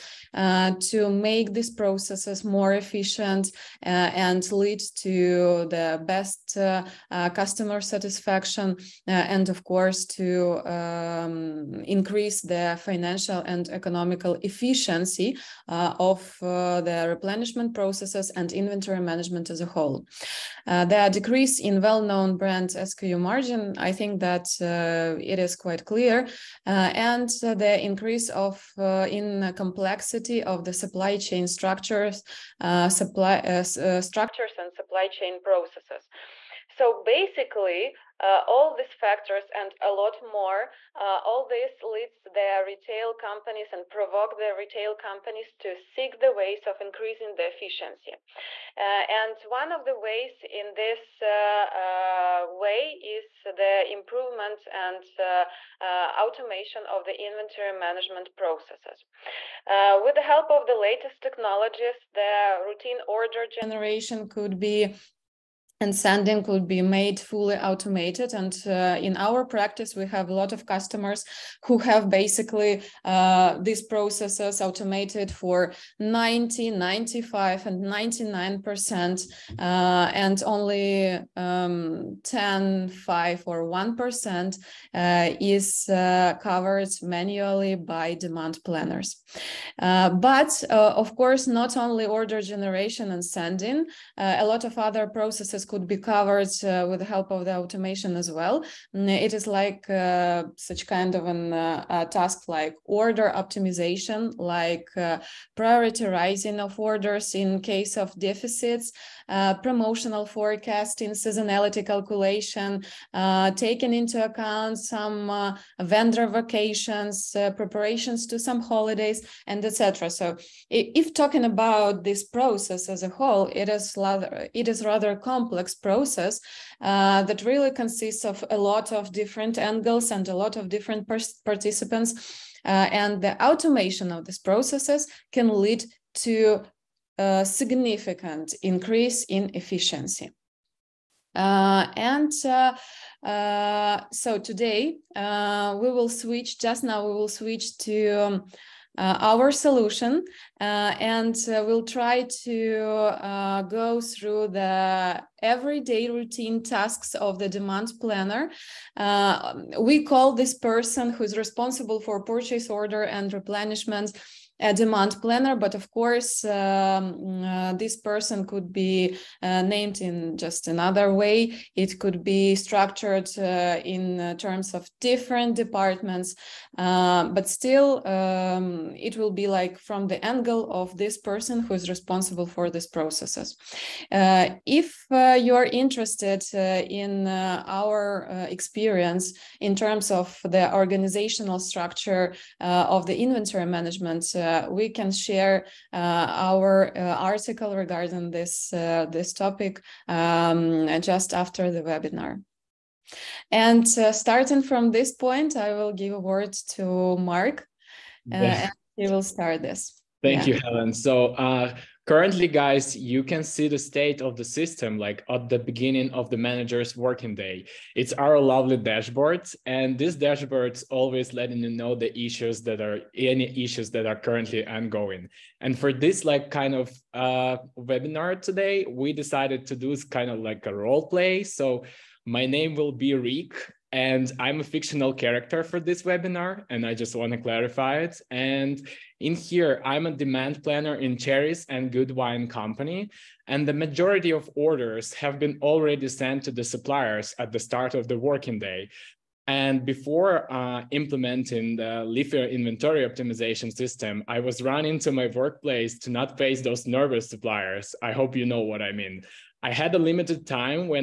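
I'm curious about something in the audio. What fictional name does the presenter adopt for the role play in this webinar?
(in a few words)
Rick.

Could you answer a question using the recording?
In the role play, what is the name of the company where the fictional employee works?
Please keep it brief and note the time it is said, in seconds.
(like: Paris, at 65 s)
Cherries and Good Wine Company, at 241 s.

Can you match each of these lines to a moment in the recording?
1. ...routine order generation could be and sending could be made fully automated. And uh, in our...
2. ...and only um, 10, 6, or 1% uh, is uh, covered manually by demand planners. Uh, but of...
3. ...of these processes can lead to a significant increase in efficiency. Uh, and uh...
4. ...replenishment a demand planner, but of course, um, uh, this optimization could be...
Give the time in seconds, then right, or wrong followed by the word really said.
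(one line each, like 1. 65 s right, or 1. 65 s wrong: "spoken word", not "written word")
1. 62 s right
2. 80 s wrong: "5", not "6"
3. 134 s right
4. 163 s wrong: "person", not "optimization".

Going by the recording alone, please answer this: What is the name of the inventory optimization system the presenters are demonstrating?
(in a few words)
Leafio.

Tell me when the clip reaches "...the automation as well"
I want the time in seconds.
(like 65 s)
97 s.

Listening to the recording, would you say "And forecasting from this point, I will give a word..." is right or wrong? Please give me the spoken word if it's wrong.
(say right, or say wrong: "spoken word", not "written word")
wrong: "starting", not "forecasting".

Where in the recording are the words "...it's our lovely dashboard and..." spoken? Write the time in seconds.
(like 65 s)
217 s.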